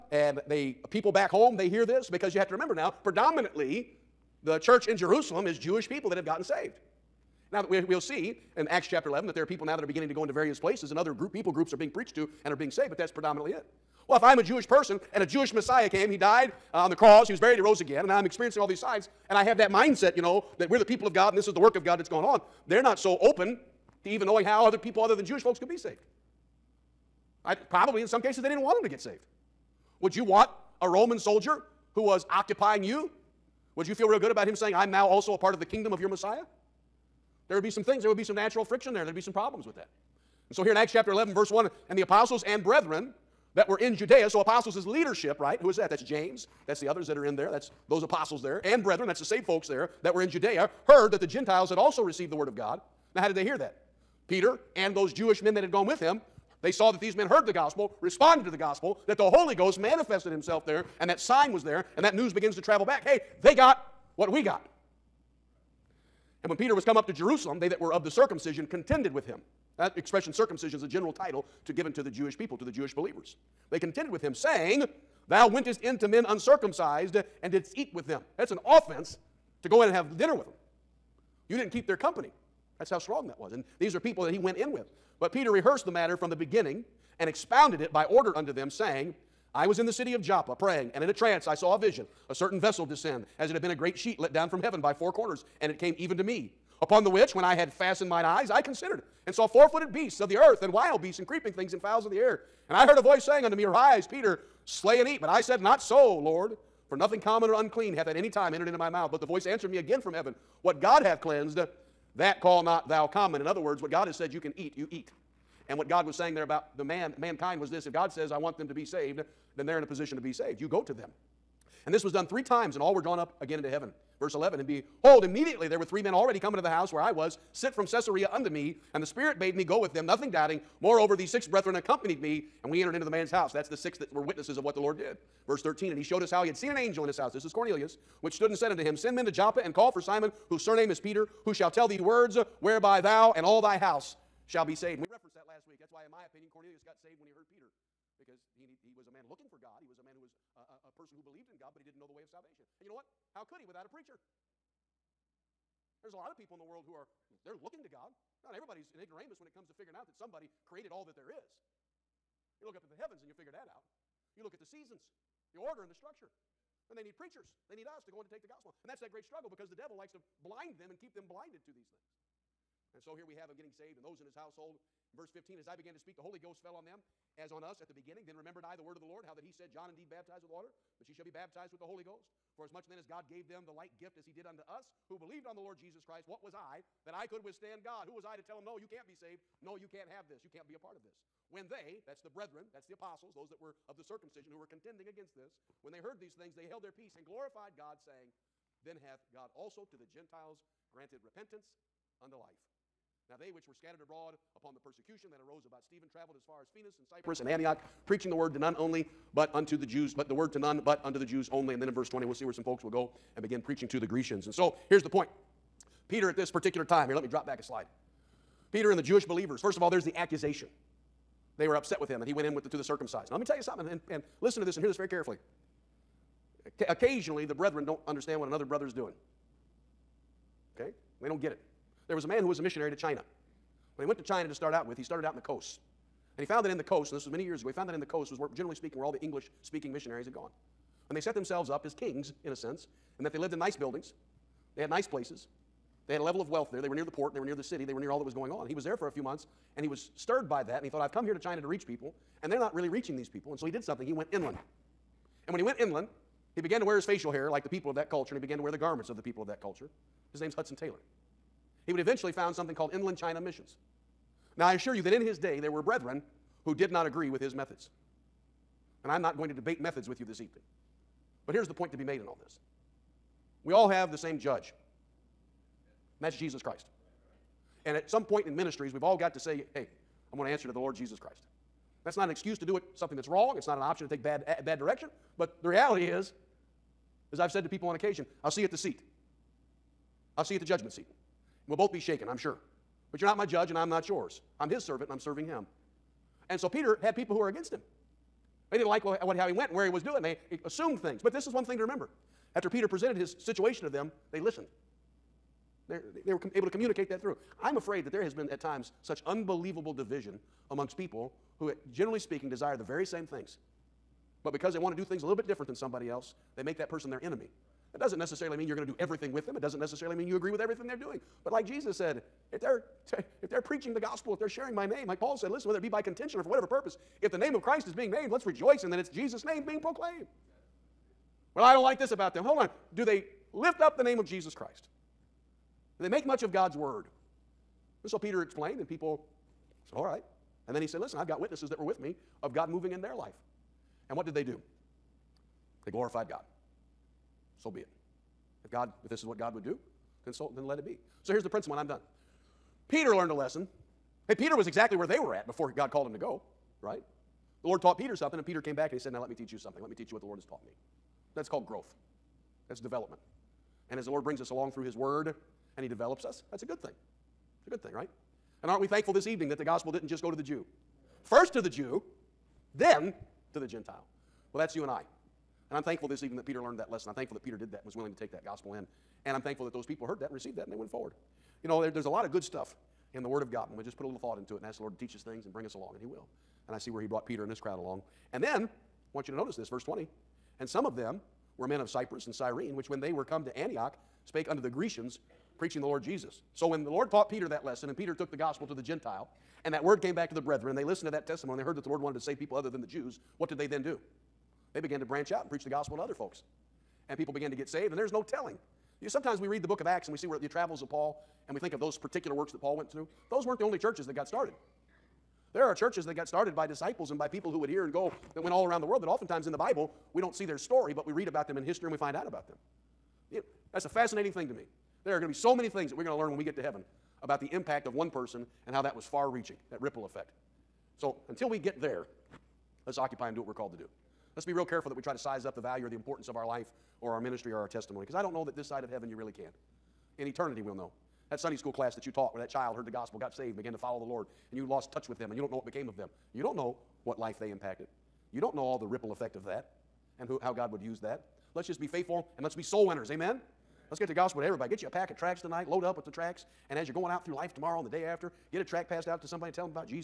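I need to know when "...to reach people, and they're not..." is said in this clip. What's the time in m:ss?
4:11.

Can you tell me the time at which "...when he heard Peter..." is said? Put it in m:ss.
2:27.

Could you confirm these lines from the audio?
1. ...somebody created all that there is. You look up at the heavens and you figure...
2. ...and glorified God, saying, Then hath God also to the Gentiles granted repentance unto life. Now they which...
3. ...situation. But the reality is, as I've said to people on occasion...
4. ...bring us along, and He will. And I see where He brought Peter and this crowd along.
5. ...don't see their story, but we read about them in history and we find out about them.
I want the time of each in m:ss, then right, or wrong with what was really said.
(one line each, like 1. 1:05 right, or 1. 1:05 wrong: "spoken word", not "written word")
1. 2:40 right
2. 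3:17 right
3. 4:44 wrong: "direction", not "situation"
4. 6:25 right
5. 7:00 right.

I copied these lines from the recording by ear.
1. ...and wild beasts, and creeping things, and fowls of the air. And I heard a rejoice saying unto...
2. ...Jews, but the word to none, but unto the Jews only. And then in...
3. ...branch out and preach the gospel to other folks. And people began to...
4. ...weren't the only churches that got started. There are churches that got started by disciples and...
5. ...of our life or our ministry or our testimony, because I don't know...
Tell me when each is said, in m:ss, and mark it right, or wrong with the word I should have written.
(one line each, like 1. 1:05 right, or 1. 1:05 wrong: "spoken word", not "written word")
1. 1:40 wrong: "voice", not "rejoice"
2. 3:29 right
3. 6:45 right
4. 6:53 right
5. 7:16 right.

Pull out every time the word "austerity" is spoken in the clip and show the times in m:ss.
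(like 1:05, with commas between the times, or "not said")
not said.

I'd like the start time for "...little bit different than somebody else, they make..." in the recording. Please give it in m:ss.
5:15.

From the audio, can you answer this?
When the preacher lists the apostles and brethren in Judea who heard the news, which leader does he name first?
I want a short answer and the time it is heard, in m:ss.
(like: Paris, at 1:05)
James, at 0:46.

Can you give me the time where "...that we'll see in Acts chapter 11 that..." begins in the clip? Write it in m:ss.
0:07.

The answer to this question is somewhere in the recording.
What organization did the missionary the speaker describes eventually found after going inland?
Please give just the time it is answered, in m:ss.
4:22.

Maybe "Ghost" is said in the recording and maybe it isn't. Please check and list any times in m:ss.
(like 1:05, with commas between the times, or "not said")
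0:59, 2:56, 3:02.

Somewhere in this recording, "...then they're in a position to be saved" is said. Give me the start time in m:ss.
1:59.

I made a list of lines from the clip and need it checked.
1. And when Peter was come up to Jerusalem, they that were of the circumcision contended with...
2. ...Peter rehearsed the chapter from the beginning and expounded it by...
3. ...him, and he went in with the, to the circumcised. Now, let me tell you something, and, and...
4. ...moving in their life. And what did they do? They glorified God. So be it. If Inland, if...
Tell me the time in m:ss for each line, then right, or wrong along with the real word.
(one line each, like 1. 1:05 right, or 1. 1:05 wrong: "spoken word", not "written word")
1. 1:06 right
2. 1:25 wrong: "matter", not "chapter"
3. 3:42 right
4. 5:42 wrong: "God", not "Inland".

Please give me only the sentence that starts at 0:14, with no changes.
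Well, if I'm a Jewish person and a Jewish Messiah came, he died, uh, on the cross.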